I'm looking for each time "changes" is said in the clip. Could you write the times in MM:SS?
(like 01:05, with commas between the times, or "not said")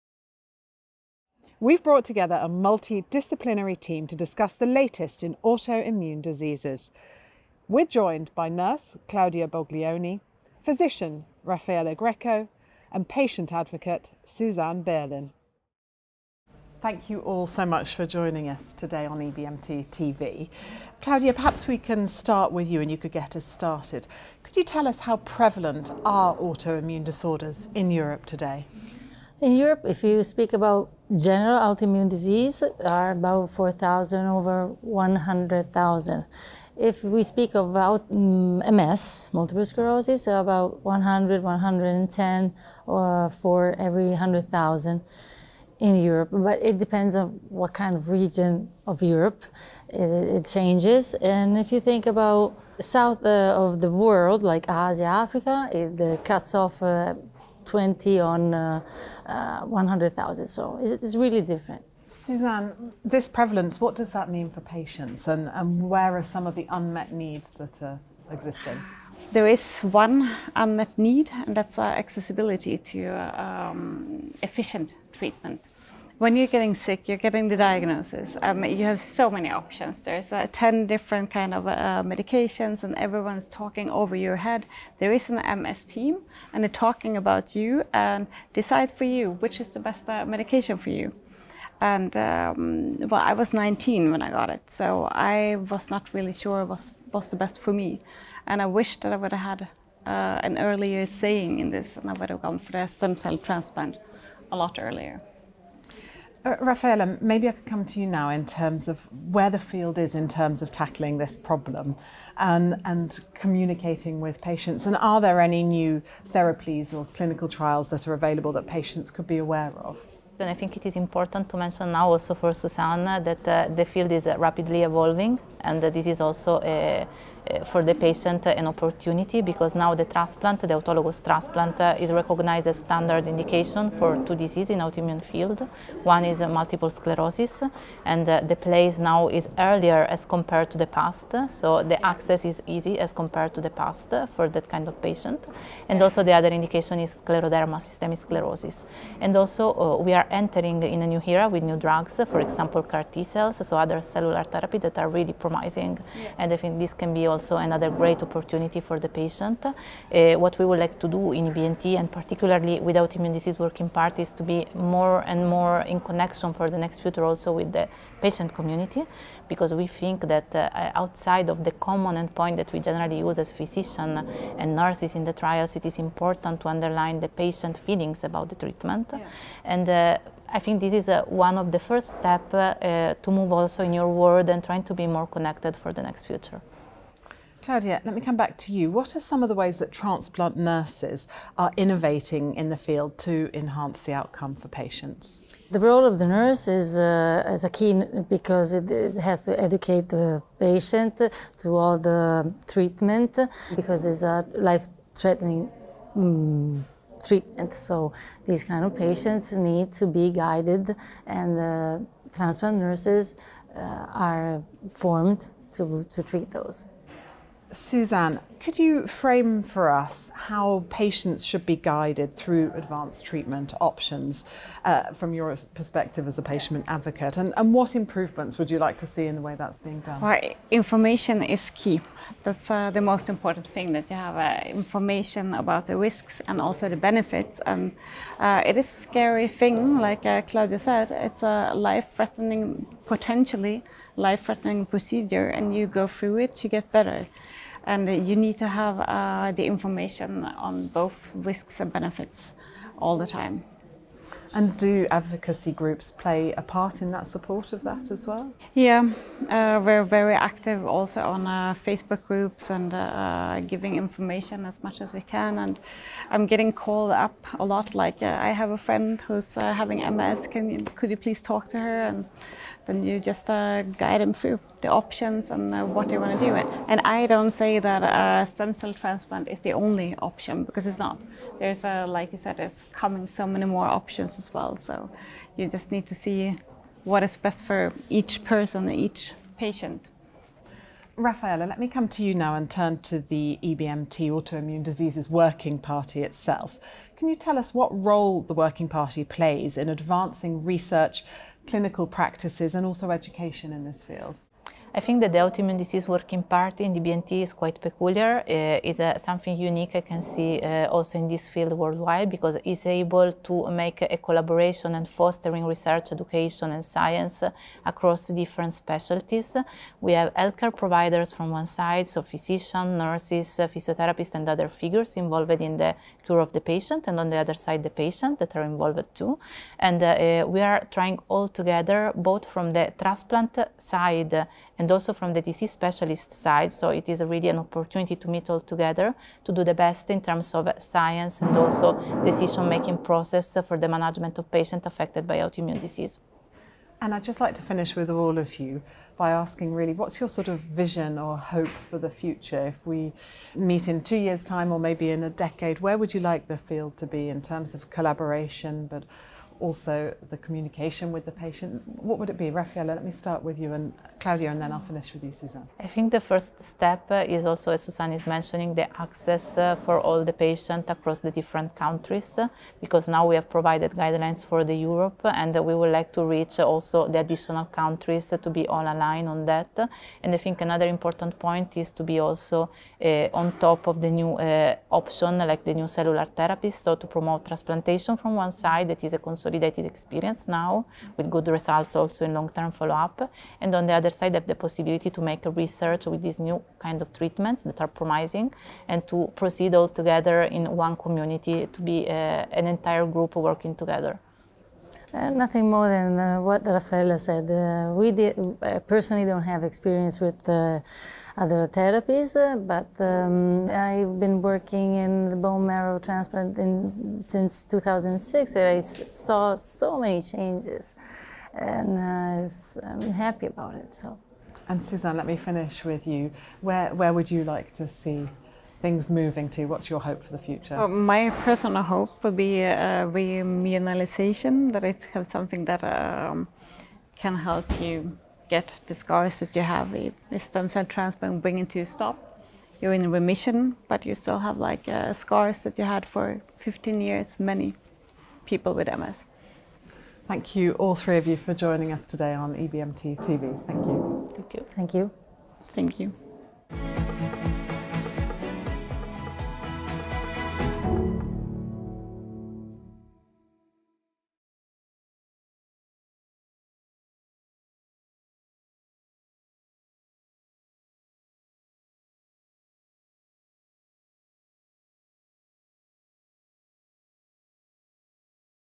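00:50, 07:00.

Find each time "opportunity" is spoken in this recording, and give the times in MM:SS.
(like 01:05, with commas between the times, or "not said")
02:08, 02:38, 05:37.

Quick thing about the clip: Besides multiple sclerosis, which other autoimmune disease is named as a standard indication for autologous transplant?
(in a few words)
Scleroderma.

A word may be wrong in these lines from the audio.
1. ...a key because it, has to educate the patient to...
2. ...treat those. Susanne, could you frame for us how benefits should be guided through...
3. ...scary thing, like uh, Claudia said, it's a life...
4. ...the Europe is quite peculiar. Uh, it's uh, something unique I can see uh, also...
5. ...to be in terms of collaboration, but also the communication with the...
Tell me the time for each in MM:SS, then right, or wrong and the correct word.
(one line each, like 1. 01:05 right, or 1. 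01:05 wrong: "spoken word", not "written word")
1. 03:17 right
2. 03:36 wrong: "patients", not "benefits"
3. 03:59 right
4. 05:06 wrong: "EBMT", not "Europe"
5. 05:56 right.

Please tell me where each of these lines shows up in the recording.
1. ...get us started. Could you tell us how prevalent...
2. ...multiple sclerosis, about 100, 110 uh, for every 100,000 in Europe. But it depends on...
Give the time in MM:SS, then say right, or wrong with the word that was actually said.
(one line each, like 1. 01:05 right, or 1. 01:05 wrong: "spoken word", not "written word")
1. 00:23 right
2. 00:39 right.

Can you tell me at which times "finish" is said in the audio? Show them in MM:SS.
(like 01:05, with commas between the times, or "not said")
05:47, 06:04, 07:05.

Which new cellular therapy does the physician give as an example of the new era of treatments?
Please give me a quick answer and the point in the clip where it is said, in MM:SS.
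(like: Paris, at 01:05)
CAR T cells, at 02:32.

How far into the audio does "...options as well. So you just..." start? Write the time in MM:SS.
04:43.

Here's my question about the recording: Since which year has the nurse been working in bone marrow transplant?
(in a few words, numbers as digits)
2006.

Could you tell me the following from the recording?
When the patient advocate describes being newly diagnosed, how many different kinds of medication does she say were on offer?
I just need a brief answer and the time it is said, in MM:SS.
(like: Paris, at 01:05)
10, at 01:20.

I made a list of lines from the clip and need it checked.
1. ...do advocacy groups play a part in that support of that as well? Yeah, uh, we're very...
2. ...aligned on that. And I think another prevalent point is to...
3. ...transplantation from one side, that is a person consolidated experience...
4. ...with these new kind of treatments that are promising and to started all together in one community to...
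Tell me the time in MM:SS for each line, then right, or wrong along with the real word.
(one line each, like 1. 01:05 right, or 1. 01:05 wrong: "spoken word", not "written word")
1. 04:14 right
2. 06:18 wrong: "important", not "prevalent"
3. 06:27 wrong: "consolidation", not "person"
4. 06:36 wrong: "proceed", not "started".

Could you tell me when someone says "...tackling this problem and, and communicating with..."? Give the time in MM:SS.
01:50.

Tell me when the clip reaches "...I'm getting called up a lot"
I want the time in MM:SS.
04:26.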